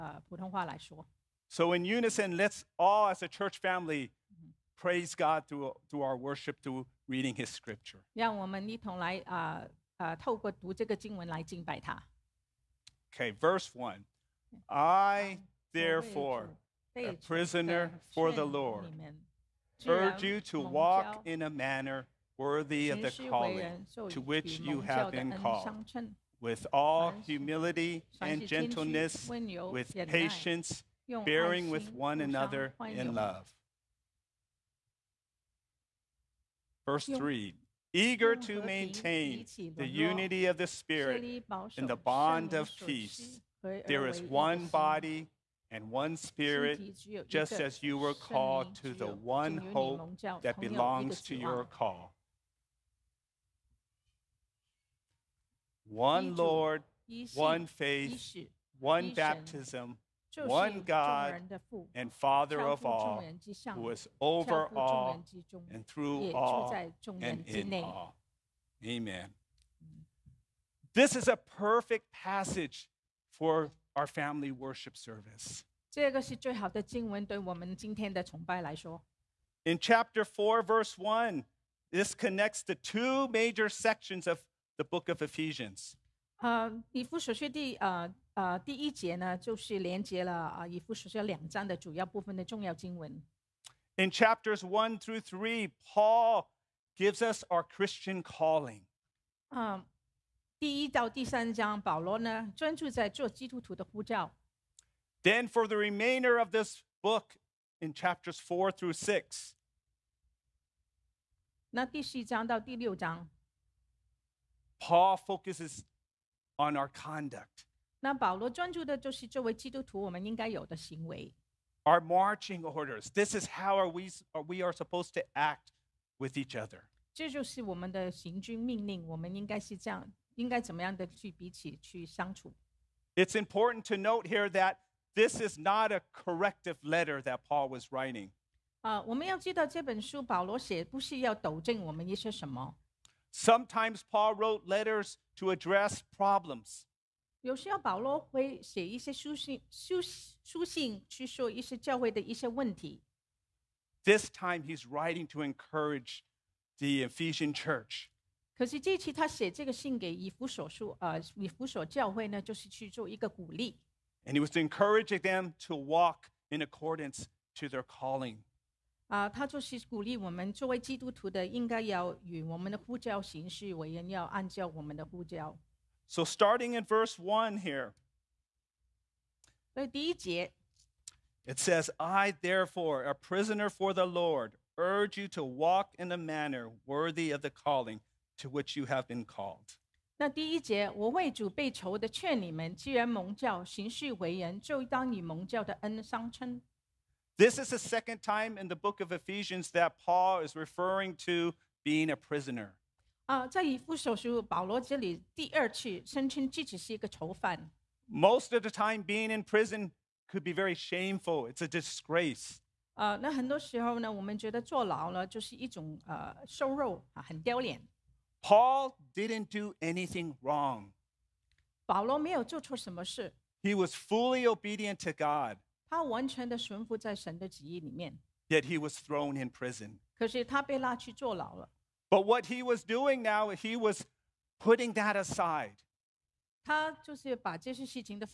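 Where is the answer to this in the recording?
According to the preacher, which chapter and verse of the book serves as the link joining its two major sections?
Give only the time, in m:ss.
1:19.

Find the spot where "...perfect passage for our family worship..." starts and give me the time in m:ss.
1:11.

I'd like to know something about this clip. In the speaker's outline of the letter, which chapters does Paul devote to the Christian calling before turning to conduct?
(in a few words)
Chapters 1 through 3.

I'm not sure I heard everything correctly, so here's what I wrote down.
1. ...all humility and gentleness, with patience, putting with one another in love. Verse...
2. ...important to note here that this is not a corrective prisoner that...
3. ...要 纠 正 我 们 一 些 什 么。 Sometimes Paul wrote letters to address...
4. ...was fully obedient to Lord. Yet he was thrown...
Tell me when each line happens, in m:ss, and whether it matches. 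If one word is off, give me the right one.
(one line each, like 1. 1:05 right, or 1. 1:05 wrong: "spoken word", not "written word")
1. 0:26 wrong: "bearing", not "putting"
2. 2:13 wrong: "letter", not "prisoner"
3. 2:21 right
4. 3:43 wrong: "God", not "Lord".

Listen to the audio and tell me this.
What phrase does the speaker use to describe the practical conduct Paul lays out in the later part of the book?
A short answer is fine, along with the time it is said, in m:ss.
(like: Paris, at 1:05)
Our marching orders, at 2:01.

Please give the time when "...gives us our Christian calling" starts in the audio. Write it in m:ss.
1:36.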